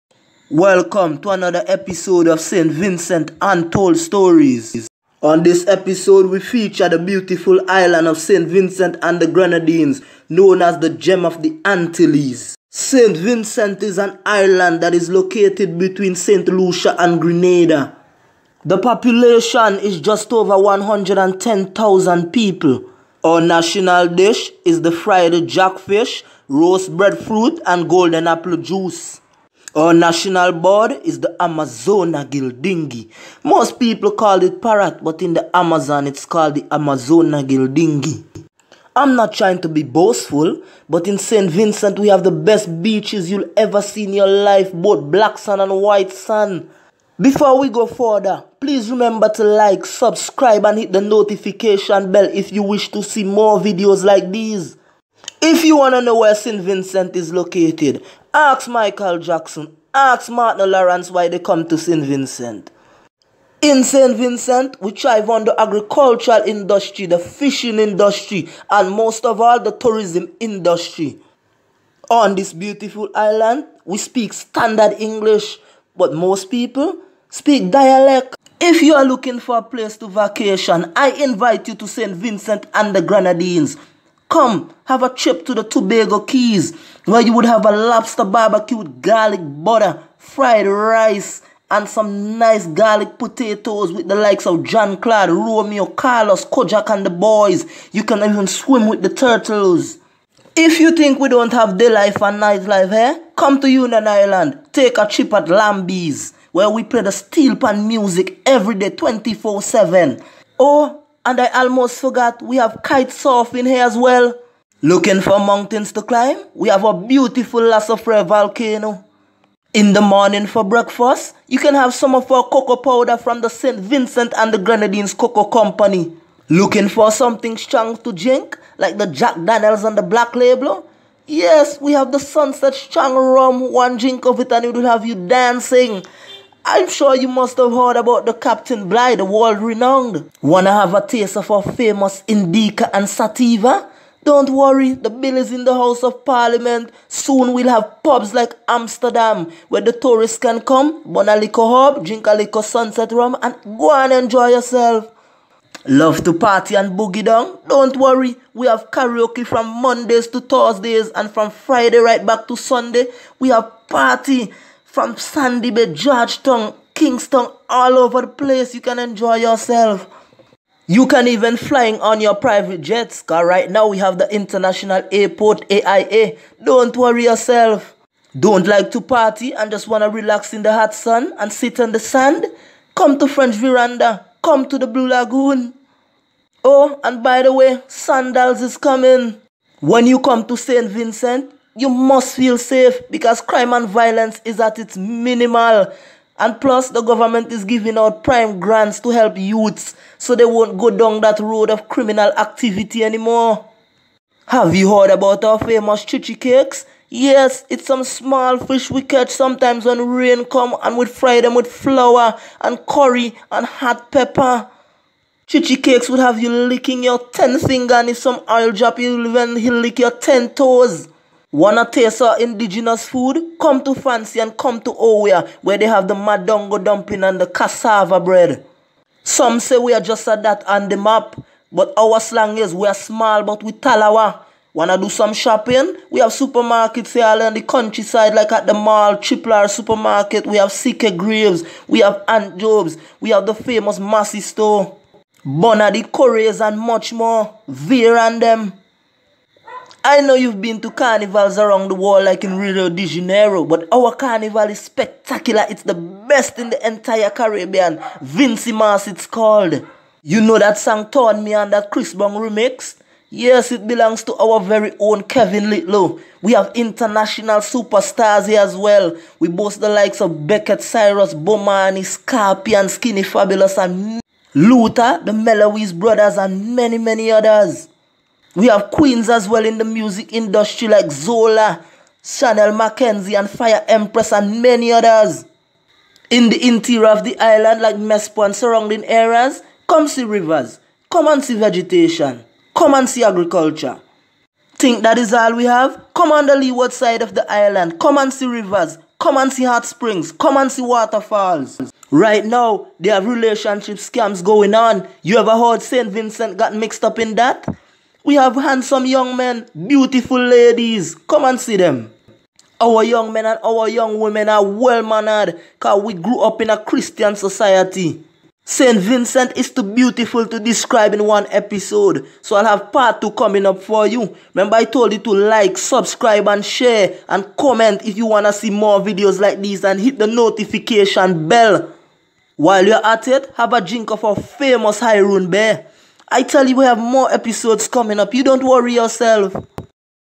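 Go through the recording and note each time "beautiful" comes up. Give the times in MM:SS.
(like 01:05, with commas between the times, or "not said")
00:06, 01:12, 01:56, 05:09, 05:19.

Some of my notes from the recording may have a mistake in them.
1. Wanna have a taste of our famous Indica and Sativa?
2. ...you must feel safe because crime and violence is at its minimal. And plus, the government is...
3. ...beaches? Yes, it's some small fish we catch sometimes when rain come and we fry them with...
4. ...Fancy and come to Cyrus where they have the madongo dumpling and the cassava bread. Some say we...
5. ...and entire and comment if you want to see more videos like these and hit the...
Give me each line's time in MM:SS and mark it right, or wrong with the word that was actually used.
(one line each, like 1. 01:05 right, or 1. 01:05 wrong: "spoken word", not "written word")
1. 02:20 right
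2. 03:11 right
3. 03:26 wrong: "cakes", not "beaches"
4. 03:43 wrong: "Owia", not "Cyrus"
5. 05:26 wrong: "share", not "entire".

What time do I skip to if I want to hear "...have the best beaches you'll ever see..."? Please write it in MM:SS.
00:42.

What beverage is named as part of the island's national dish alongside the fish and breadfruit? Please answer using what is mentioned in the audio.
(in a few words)
Golden apple juice.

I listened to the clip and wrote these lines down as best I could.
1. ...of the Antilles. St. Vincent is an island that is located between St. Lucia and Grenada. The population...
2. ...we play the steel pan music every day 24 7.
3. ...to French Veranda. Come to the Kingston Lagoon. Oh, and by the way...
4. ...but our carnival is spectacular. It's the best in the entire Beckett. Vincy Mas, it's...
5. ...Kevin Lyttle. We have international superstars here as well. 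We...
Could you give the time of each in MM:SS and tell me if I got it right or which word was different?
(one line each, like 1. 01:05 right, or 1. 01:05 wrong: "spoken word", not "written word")
1. 00:11 right
2. 01:46 right
3. 03:03 wrong: "Blue", not "Kingston"
4. 04:13 wrong: "Caribbean", not "Beckett"
5. 04:25 right.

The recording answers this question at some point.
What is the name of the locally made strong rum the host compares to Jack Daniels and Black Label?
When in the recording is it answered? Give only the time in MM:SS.
02:12.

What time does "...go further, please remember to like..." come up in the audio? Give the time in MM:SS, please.
00:47.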